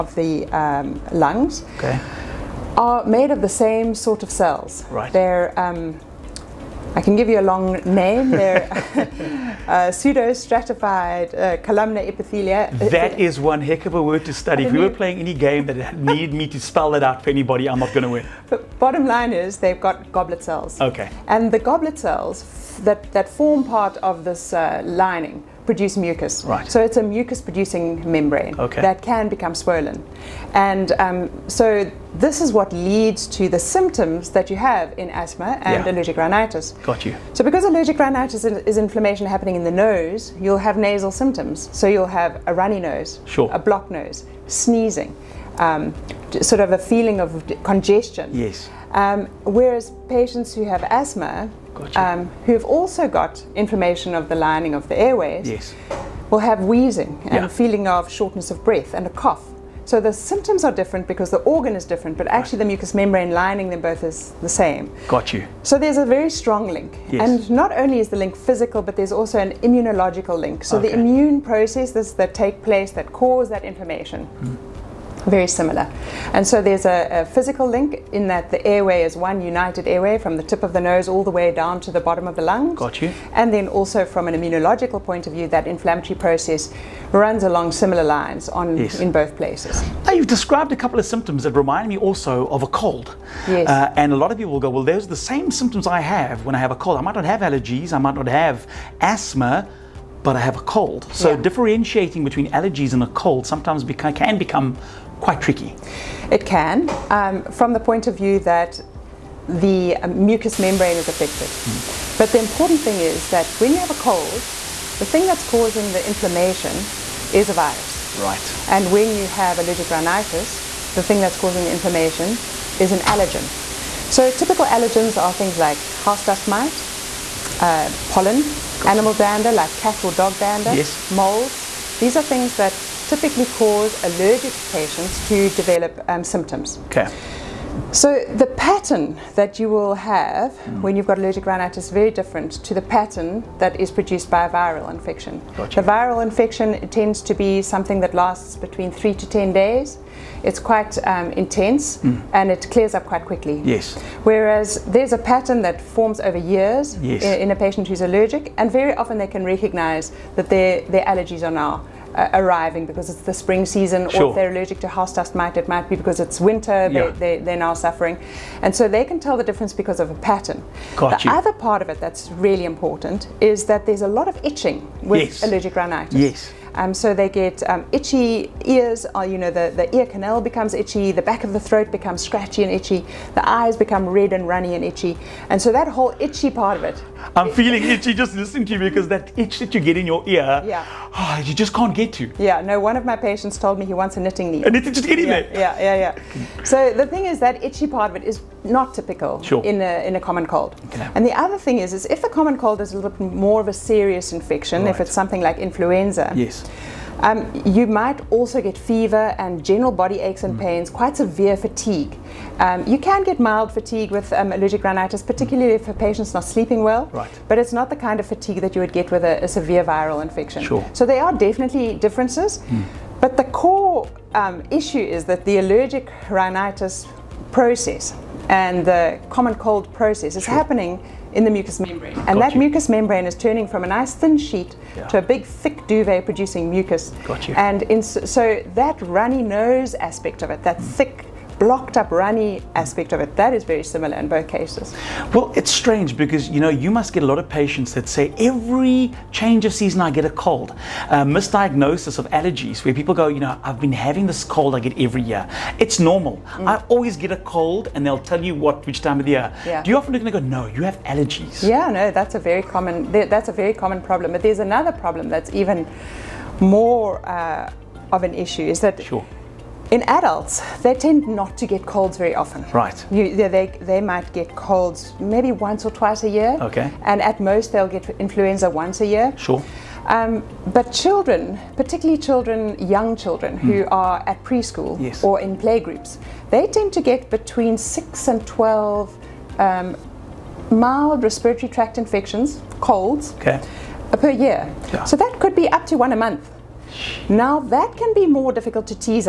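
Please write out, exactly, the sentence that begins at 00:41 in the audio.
So you'll have a runny nose, sure.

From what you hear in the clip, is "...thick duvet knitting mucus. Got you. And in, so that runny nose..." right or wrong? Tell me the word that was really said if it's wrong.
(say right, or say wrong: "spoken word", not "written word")
wrong: "producing", not "knitting".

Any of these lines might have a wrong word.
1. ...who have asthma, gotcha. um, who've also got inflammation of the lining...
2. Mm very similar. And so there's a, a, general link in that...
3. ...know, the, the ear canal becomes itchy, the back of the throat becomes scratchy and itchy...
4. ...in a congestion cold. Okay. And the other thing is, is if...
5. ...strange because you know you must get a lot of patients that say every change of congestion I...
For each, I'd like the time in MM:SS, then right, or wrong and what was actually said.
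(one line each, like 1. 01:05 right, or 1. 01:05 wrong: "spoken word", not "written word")
1. 00:50 right
2. 01:14 wrong: "physical", not "general"
3. 02:59 right
4. 03:20 wrong: "common", not "congestion"
5. 04:05 wrong: "season", not "congestion".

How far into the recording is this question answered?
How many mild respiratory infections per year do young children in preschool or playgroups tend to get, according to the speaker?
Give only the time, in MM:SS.
04:47.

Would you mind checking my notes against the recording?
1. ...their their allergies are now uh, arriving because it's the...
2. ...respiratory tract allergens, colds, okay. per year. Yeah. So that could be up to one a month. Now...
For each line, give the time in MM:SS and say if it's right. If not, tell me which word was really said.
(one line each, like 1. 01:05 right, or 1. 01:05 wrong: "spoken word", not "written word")
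1. 02:40 right
2. 04:51 wrong: "infections", not "allergens".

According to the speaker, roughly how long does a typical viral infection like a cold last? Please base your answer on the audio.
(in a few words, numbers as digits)
3 to 10 days.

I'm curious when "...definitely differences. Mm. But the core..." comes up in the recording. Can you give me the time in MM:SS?
03:41.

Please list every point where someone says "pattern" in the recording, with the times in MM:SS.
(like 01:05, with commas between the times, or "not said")
02:18, 02:22, 02:35, 02:50.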